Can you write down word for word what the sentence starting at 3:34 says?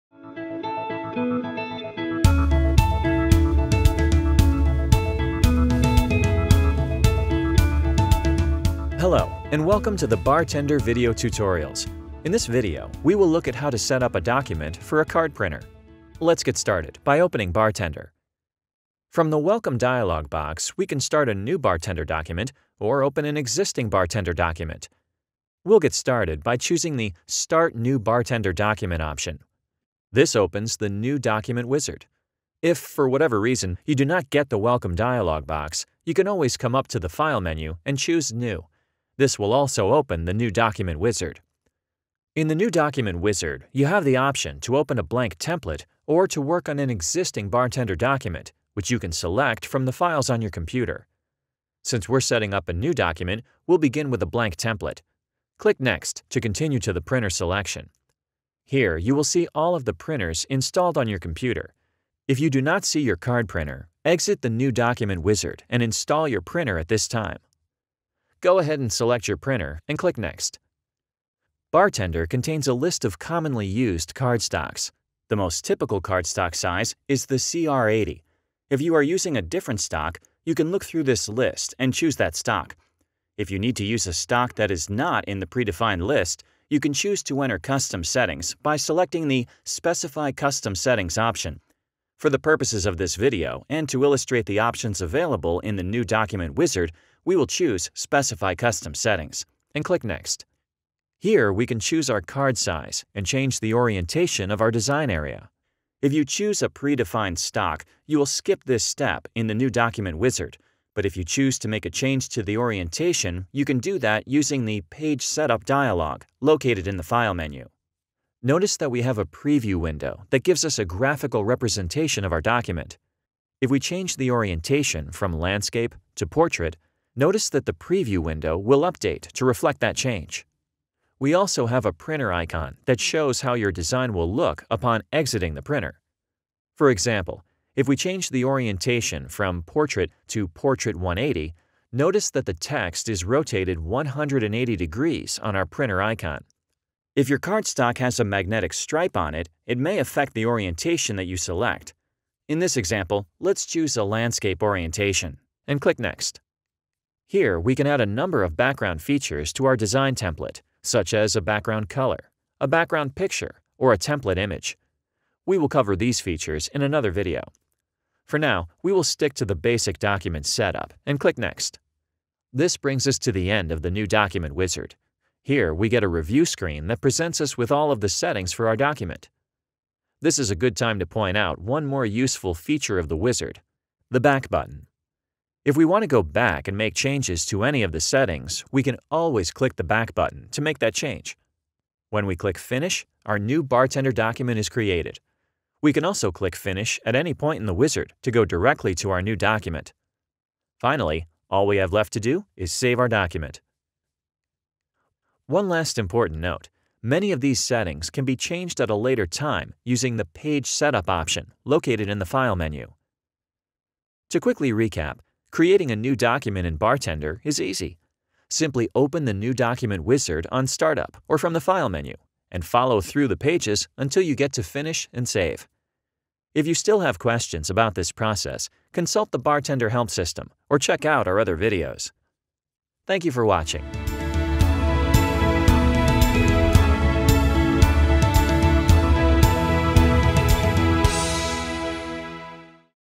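To quickly recap, Creating a new document in BarTender is easy.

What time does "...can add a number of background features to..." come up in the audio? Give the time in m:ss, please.
2:37.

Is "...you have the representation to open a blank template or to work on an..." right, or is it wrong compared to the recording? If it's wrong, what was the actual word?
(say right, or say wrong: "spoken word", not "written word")
wrong: "option", not "representation".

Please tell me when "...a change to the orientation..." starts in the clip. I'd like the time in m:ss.
1:51.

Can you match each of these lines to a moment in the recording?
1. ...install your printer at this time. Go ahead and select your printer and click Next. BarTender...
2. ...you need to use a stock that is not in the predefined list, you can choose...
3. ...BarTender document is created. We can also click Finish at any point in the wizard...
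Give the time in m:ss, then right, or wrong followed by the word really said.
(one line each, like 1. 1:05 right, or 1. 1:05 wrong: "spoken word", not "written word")
1. 1:05 right
2. 1:23 right
3. 3:13 right.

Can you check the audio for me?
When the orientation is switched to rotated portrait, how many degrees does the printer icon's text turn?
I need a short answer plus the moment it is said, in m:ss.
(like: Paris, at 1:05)
180, at 2:23.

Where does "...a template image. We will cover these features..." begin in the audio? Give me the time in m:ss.
2:43.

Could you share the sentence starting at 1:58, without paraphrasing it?
Notice that we have a preview window that gives us a graphical representation of our document.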